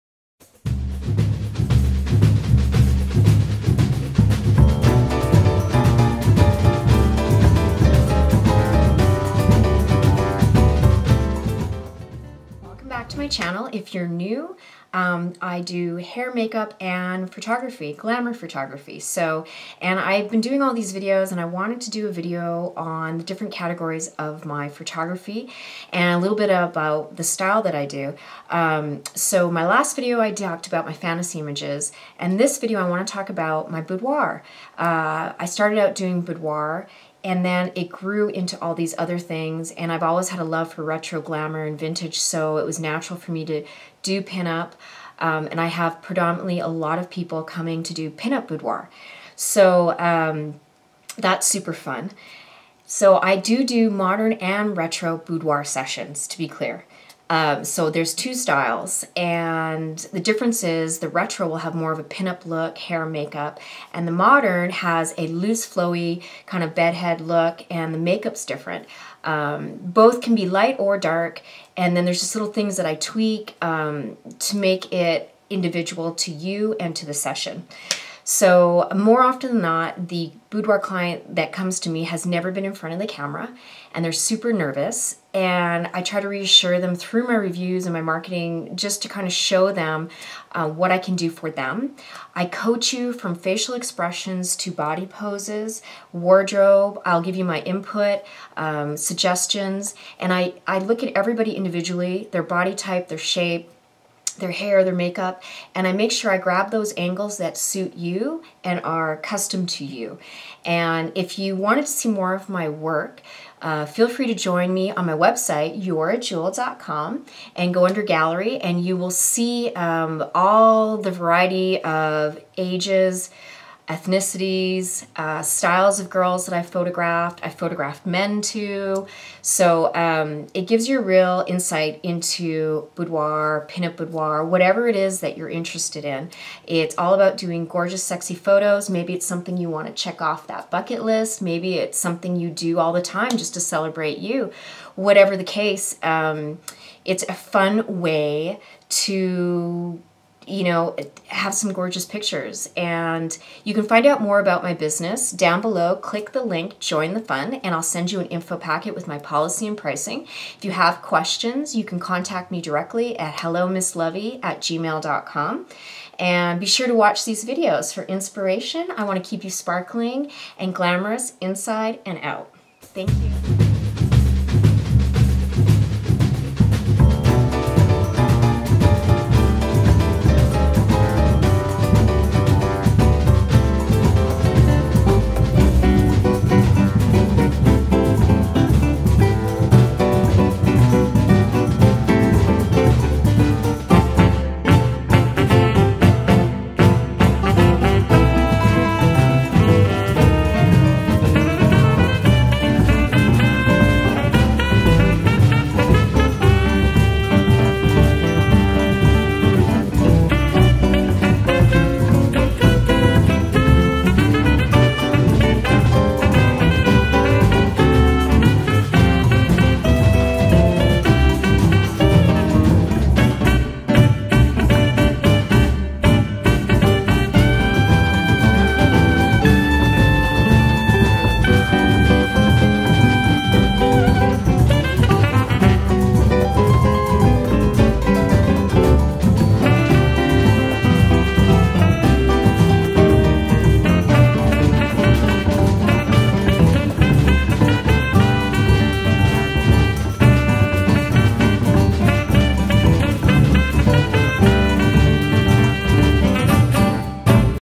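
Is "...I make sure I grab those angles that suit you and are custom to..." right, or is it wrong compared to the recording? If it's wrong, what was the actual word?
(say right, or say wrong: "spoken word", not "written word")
right.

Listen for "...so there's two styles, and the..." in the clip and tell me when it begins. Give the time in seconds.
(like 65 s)
57 s.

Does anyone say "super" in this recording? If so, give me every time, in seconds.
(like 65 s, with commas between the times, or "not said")
51 s, 84 s.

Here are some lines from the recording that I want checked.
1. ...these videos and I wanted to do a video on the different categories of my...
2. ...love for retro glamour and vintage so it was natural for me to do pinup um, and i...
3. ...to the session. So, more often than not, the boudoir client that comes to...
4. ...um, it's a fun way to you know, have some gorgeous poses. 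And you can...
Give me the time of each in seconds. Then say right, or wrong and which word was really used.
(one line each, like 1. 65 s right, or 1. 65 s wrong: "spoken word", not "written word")
1. 20 s right
2. 40 s right
3. 76 s right
4. 146 s wrong: "pictures", not "poses".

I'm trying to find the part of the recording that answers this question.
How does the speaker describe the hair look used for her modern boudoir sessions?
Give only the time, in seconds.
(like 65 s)
66 s.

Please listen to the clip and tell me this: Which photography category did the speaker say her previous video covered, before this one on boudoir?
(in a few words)
Fantasy images.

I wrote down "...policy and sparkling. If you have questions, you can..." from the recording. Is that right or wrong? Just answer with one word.
wrong.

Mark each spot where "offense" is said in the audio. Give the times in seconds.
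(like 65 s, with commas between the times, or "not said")
not said.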